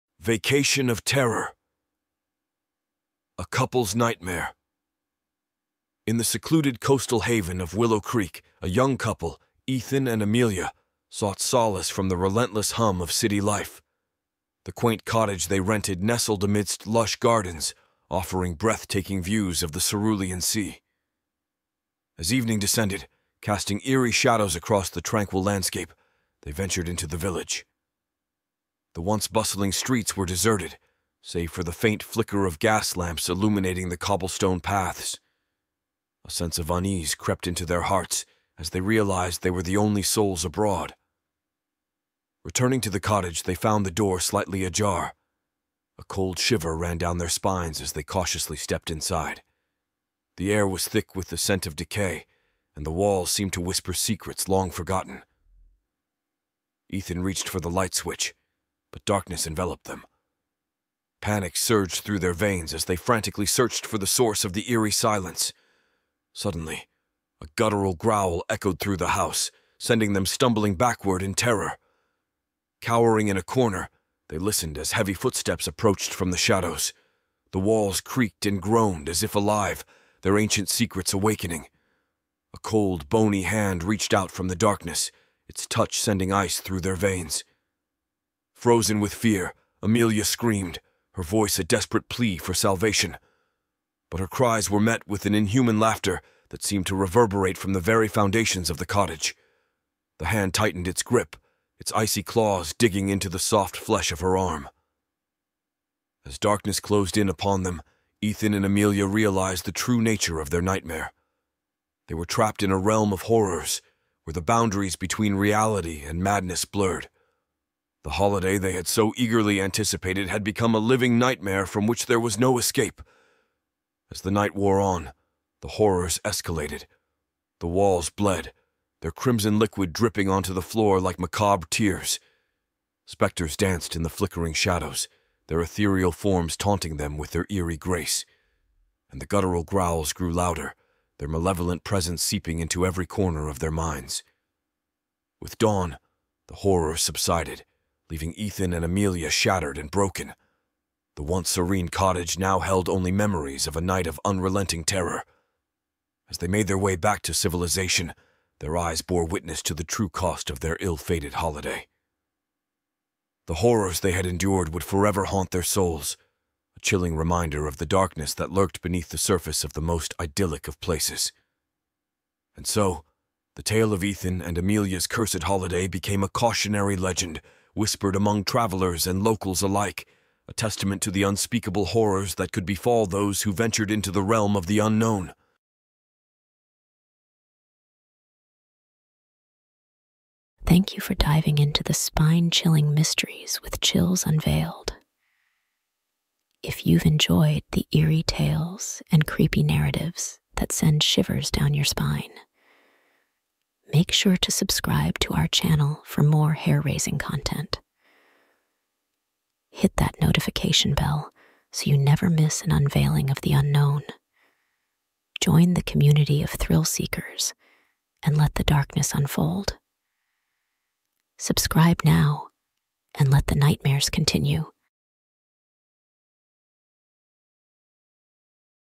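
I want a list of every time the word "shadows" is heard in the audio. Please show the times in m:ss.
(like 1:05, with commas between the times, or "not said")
0:24, 1:16, 2:14.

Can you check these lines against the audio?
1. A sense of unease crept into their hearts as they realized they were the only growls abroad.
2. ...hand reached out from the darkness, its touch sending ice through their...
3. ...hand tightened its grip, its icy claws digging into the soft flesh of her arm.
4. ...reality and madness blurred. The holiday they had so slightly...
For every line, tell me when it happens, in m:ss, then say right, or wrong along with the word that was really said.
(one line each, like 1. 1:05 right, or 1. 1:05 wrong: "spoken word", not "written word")
1. 0:36 wrong: "souls", not "growls"
2. 1:23 right
3. 1:40 right
4. 1:55 wrong: "eagerly", not "slightly".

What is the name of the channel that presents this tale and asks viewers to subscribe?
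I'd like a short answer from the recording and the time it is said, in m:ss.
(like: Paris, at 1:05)
Chills Unveiled, at 3:13.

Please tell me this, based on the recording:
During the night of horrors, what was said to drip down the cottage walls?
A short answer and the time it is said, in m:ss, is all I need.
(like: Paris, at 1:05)
Crimson liquid, at 2:09.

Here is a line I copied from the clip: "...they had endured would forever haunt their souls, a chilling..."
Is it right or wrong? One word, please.
right.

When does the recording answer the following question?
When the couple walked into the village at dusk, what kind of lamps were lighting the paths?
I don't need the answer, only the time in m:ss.
0:32.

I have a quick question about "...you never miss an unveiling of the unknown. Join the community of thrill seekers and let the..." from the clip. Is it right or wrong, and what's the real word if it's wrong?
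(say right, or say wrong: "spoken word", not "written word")
right.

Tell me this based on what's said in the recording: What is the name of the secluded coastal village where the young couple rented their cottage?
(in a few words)
Willow Creek.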